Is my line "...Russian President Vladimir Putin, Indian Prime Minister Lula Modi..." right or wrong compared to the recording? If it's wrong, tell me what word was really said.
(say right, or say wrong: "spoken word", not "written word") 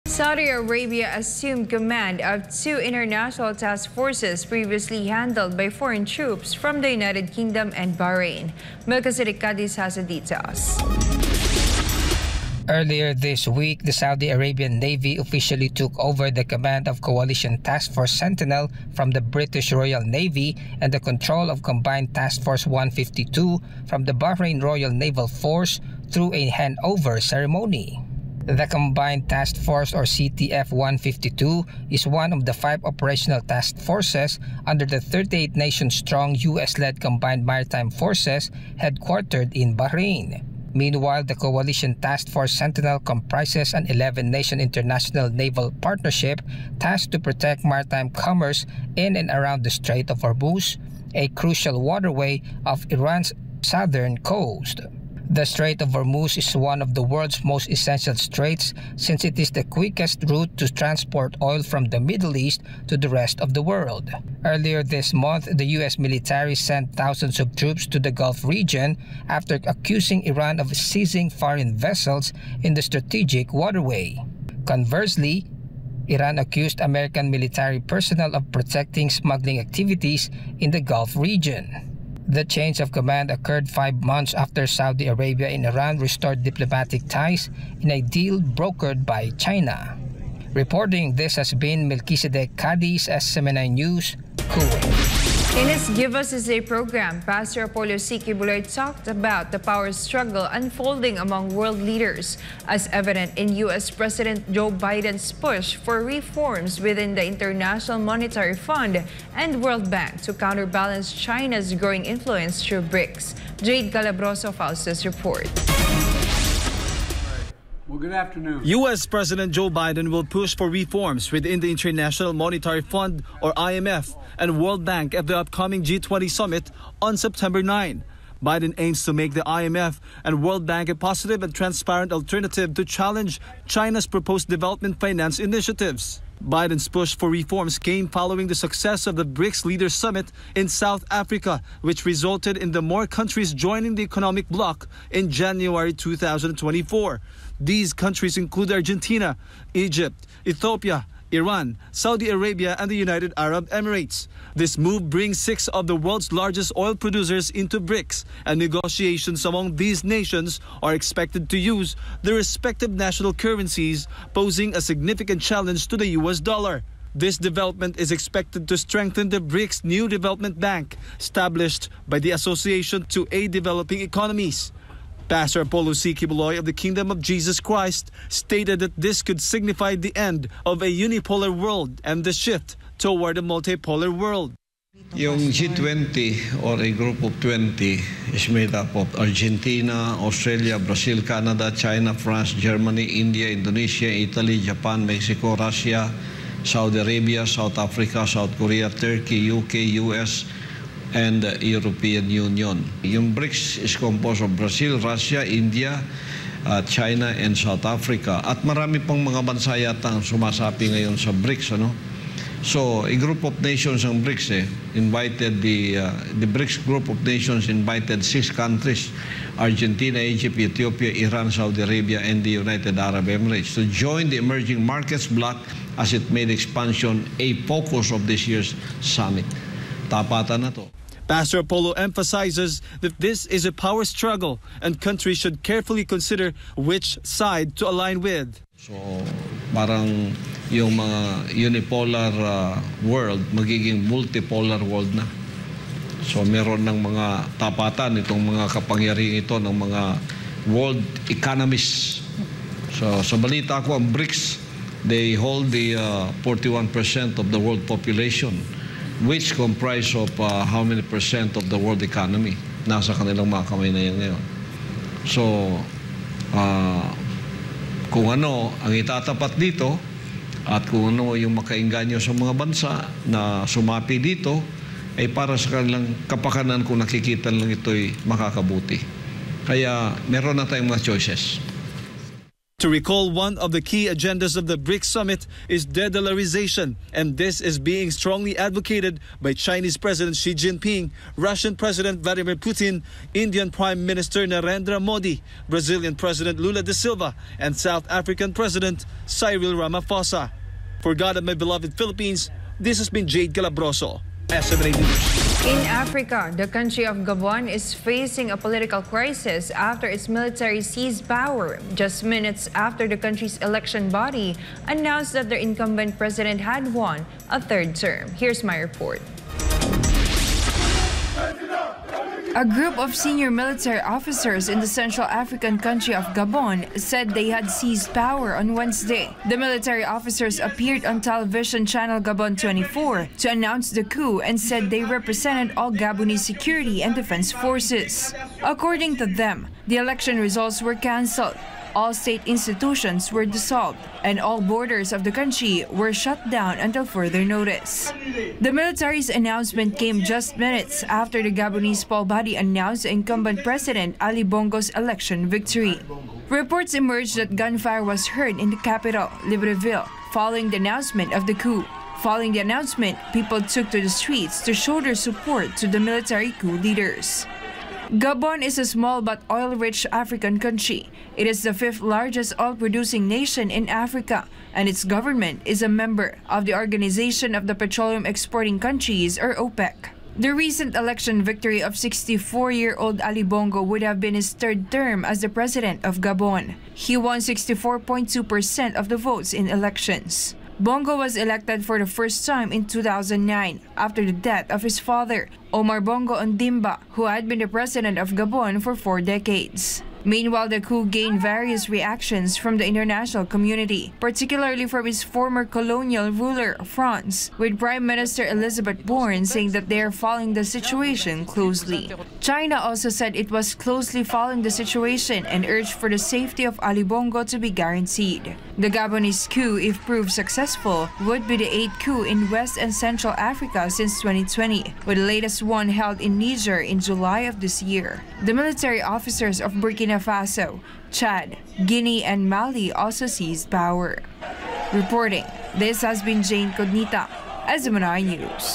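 wrong: "Narendra", not "Lula".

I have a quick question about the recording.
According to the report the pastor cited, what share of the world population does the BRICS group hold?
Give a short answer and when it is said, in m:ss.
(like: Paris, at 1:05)
41%, at 4:16.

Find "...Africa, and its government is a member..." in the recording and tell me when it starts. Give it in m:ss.
6:13.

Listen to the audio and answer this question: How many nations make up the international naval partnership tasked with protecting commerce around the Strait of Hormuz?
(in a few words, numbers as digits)
11.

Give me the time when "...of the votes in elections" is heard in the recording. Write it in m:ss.
6:28.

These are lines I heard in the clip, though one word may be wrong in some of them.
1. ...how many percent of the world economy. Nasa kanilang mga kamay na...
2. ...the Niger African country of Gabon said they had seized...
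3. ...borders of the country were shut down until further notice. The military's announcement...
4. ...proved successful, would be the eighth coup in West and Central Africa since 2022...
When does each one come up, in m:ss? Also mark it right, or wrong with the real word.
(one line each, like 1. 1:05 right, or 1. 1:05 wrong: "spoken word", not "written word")
1. 4:20 right
2. 5:24 wrong: "Central", not "Niger"
3. 5:44 right
4. 7:00 wrong: "2020", not "2022".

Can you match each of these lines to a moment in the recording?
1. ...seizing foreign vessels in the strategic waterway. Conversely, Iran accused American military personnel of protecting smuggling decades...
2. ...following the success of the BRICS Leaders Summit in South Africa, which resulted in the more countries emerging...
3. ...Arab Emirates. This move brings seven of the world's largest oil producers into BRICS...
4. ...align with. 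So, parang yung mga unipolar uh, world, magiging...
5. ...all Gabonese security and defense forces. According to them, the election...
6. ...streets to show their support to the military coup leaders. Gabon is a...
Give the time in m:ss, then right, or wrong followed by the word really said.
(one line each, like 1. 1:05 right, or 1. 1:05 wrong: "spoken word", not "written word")
1. 1:10 wrong: "activities", not "decades"
2. 2:18 wrong: "joining", not "emerging"
3. 2:33 wrong: "six", not "seven"
4. 3:57 right
5. 5:35 right
6. 6:04 right.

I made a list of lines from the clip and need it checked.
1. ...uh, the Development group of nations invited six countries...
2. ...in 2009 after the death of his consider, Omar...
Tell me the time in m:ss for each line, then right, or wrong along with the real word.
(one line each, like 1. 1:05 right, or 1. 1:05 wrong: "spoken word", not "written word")
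1. 3:35 wrong: "BRICS", not "Development"
2. 6:32 wrong: "father", not "consider".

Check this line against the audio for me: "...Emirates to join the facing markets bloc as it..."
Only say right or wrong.
wrong.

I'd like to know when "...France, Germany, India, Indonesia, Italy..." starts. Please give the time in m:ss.
3:12.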